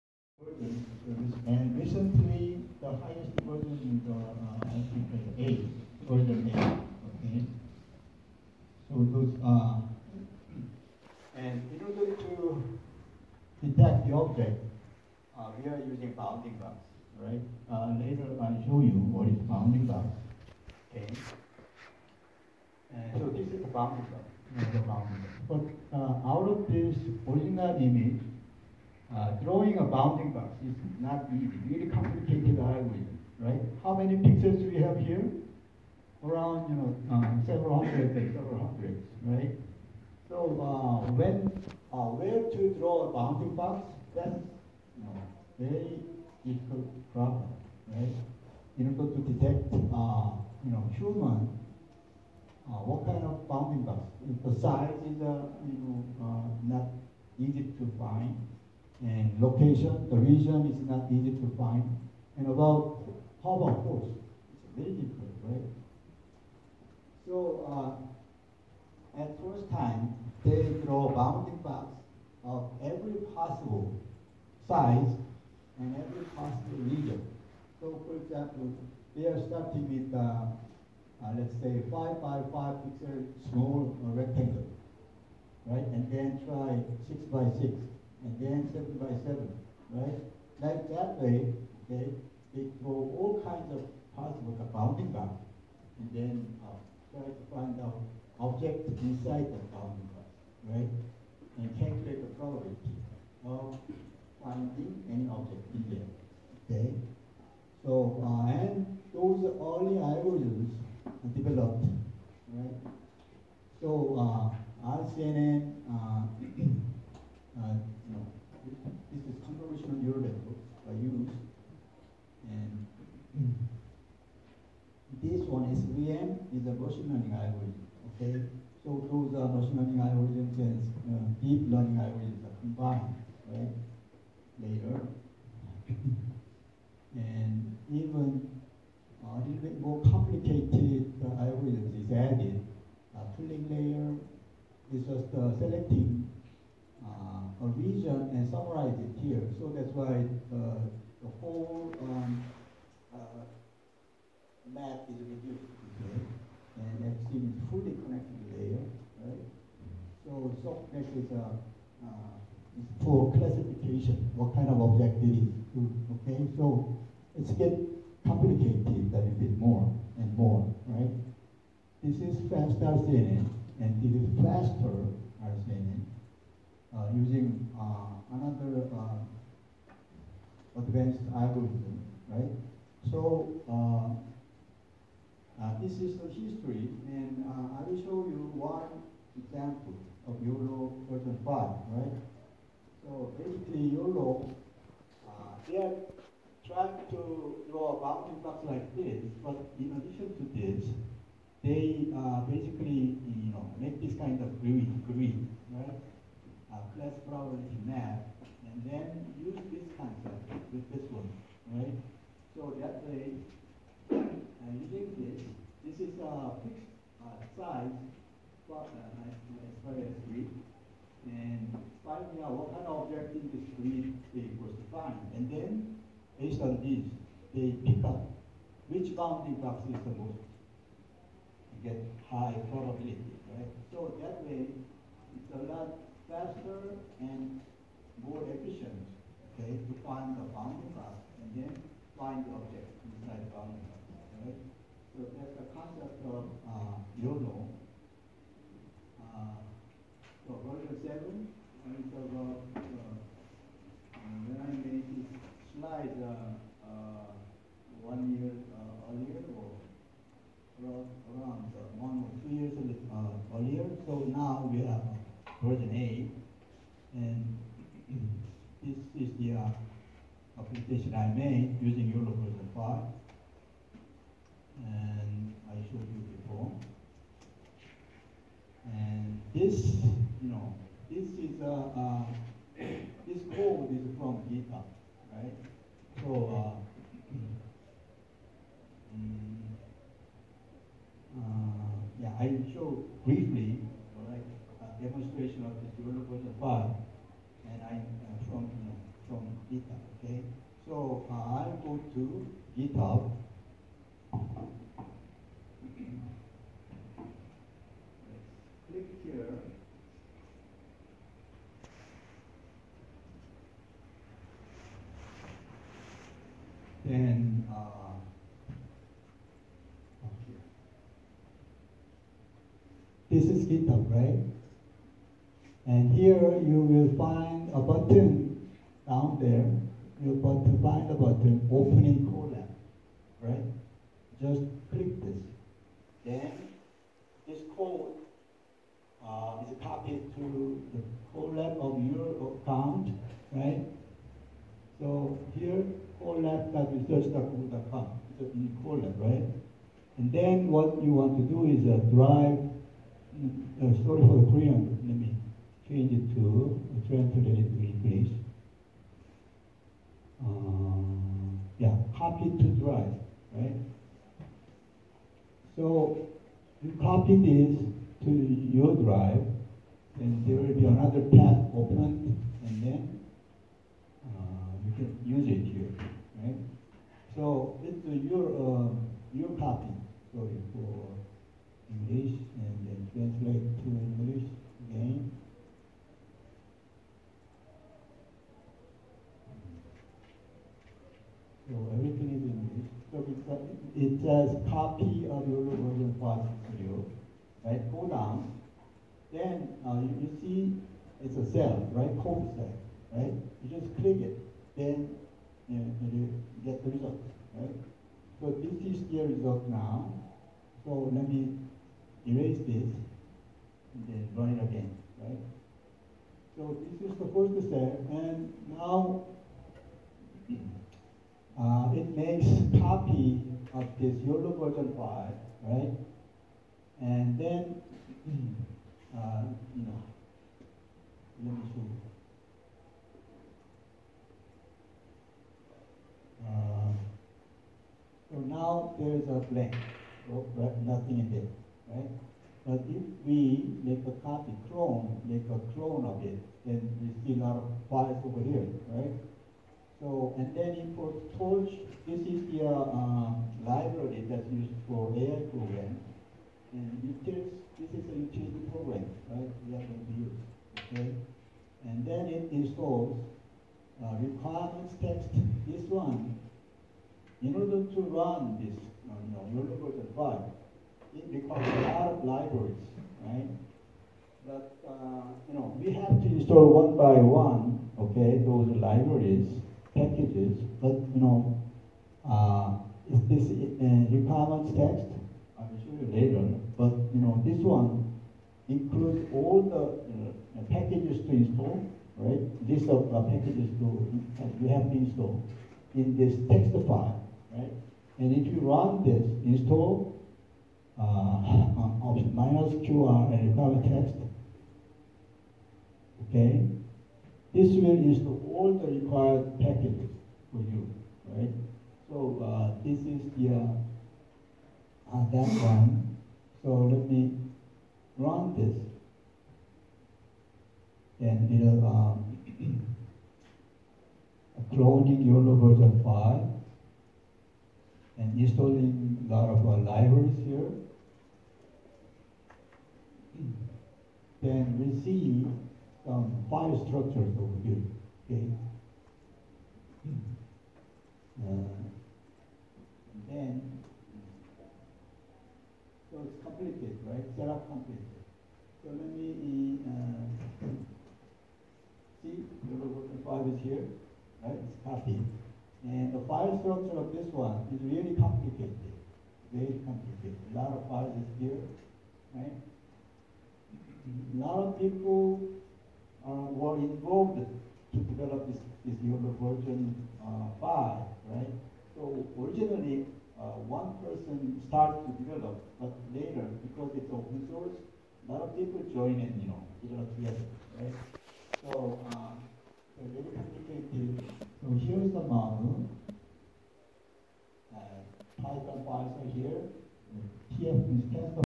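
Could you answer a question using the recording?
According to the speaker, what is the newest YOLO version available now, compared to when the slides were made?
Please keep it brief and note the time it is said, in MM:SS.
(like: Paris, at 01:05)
version 8, at 04:25.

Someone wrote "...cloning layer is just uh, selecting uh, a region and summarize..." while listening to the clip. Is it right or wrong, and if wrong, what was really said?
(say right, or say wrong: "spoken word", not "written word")
wrong: "pooling", not "cloning".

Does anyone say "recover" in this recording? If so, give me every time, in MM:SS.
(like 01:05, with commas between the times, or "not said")
08:23.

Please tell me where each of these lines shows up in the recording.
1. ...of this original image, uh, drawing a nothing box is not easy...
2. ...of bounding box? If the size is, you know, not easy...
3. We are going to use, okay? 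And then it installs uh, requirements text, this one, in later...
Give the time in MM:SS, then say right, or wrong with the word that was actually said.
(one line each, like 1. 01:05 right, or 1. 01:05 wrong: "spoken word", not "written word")
1. 00:26 wrong: "bounding", not "nothing"
2. 00:53 right
3. 07:39 wrong: "order", not "later".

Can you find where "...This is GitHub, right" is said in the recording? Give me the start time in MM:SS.
05:23.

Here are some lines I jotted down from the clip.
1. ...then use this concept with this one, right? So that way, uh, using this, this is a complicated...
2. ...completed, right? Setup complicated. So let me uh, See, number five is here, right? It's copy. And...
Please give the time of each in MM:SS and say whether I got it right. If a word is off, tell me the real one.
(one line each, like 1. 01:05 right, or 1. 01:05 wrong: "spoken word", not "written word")
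1. 03:28 wrong: "fixed", not "complicated"
2. 09:06 right.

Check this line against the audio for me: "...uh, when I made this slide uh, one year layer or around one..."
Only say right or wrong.
wrong.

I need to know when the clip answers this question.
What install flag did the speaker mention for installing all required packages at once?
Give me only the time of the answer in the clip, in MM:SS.
08:22.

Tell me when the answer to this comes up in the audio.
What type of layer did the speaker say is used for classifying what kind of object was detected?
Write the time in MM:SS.
02:40.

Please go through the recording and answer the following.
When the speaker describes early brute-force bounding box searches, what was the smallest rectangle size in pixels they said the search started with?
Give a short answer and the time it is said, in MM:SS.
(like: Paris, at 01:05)
5 by 5, at 01:21.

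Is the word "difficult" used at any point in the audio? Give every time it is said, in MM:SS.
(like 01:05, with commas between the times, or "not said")
00:46, 01:04.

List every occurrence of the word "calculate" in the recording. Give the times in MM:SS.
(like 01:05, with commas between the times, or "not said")
01:41.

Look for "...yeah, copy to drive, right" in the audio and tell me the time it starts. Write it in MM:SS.
06:01.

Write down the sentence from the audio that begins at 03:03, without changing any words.
So uh, uh, this is the history, and I will show you one example of YOLO version 5, right?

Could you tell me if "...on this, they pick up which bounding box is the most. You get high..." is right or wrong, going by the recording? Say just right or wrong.
right.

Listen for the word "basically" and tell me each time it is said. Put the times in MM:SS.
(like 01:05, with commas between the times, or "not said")
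03:13, 03:22.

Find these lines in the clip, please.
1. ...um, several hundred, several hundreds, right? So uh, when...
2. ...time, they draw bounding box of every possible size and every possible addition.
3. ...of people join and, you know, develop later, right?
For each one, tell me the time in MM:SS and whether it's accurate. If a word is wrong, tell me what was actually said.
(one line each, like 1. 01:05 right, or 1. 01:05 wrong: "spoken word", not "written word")
1. 00:37 right
2. 01:09 wrong: "region", not "addition"
3. 09:38 wrong: "together", not "later".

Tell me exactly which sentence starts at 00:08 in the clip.
So those uh, and in order to detect the object, uh, we are using bounding box, right?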